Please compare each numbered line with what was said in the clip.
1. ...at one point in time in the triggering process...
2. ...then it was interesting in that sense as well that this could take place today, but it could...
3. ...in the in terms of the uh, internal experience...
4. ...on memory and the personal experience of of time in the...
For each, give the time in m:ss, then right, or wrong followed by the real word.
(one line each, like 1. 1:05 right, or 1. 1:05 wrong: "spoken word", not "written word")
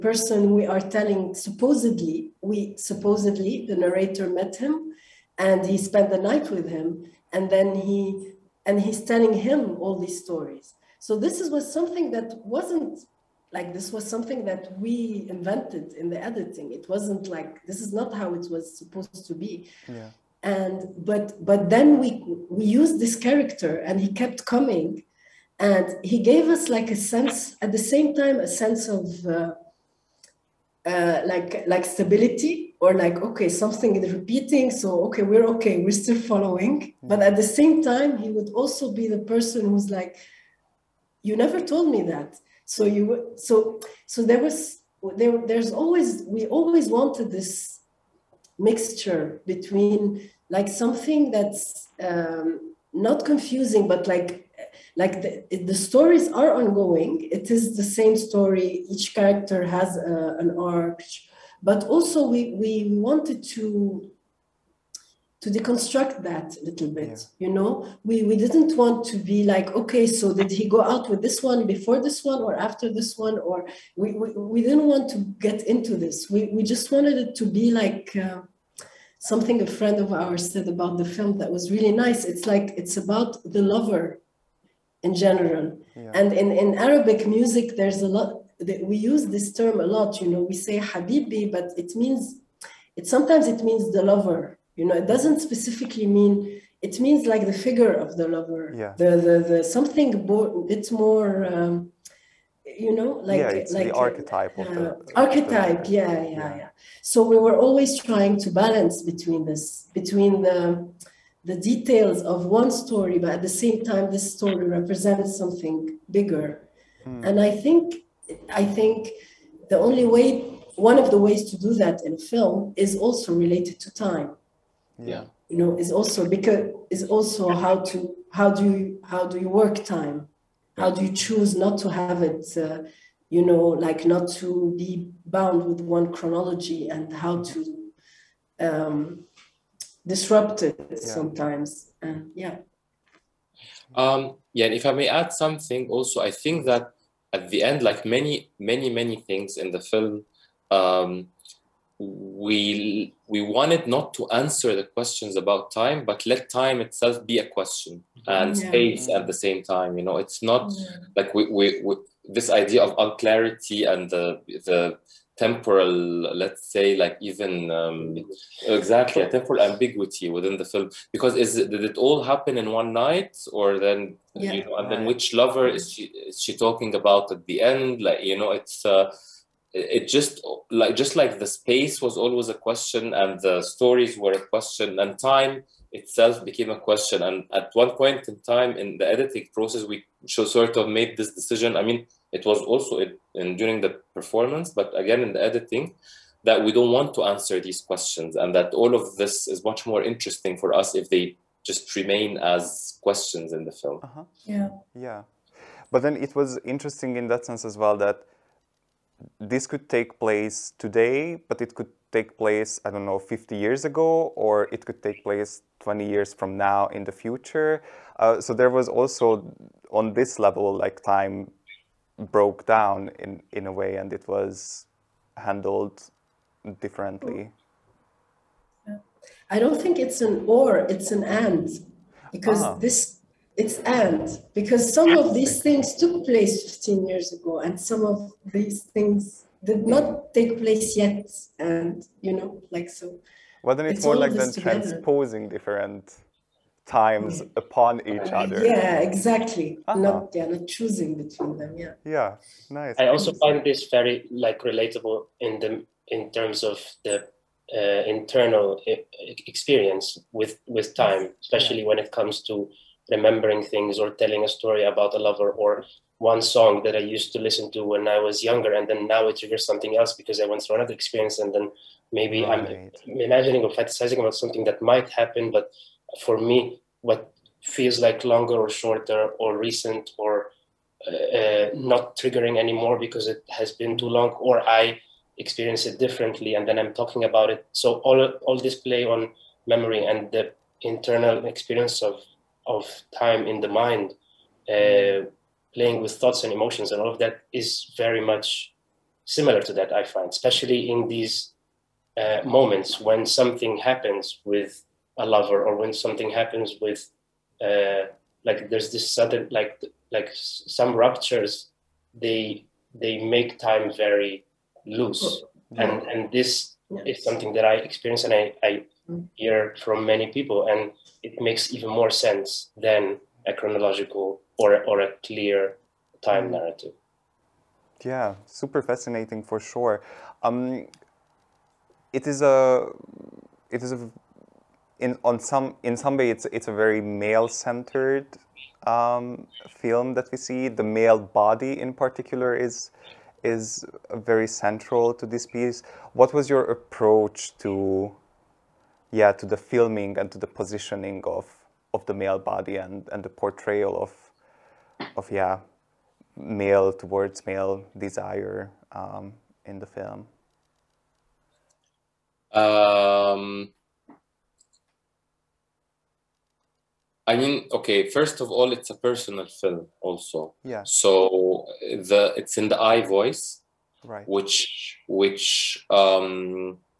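1. 3:07 wrong: "editing", not "triggering"
2. 3:26 right
3. 4:15 right
4. 4:49 wrong: "internal", not "personal".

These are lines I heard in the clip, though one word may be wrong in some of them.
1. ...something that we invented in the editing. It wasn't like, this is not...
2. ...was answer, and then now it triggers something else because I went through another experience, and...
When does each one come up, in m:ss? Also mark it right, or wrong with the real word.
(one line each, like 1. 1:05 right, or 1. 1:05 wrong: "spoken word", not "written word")
1. 0:14 right
2. 4:28 wrong: "younger", not "answer".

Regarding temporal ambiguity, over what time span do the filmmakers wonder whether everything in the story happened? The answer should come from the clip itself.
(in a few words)
One night.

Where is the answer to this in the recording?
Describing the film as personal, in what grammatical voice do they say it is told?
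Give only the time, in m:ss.
6:12.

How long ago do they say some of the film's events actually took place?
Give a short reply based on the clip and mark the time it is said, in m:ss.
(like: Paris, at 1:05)
15 years, at 3:56.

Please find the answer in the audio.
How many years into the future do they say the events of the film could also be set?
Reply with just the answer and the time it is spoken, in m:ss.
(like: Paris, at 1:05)
20, at 3:35.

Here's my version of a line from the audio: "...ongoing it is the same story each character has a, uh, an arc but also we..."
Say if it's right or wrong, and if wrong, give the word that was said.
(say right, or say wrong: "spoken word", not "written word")
right.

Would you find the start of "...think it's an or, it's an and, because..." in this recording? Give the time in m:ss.
3:49.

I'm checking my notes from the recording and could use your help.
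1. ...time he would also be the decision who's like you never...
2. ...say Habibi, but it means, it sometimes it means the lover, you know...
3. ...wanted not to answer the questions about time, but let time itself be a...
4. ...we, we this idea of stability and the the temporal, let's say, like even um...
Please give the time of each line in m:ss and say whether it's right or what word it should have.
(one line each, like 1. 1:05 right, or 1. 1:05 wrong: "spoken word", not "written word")
1. 0:37 wrong: "person", not "decision"
2. 1:30 right
3. 2:33 right
4. 2:41 wrong: "unclarity", not "stability".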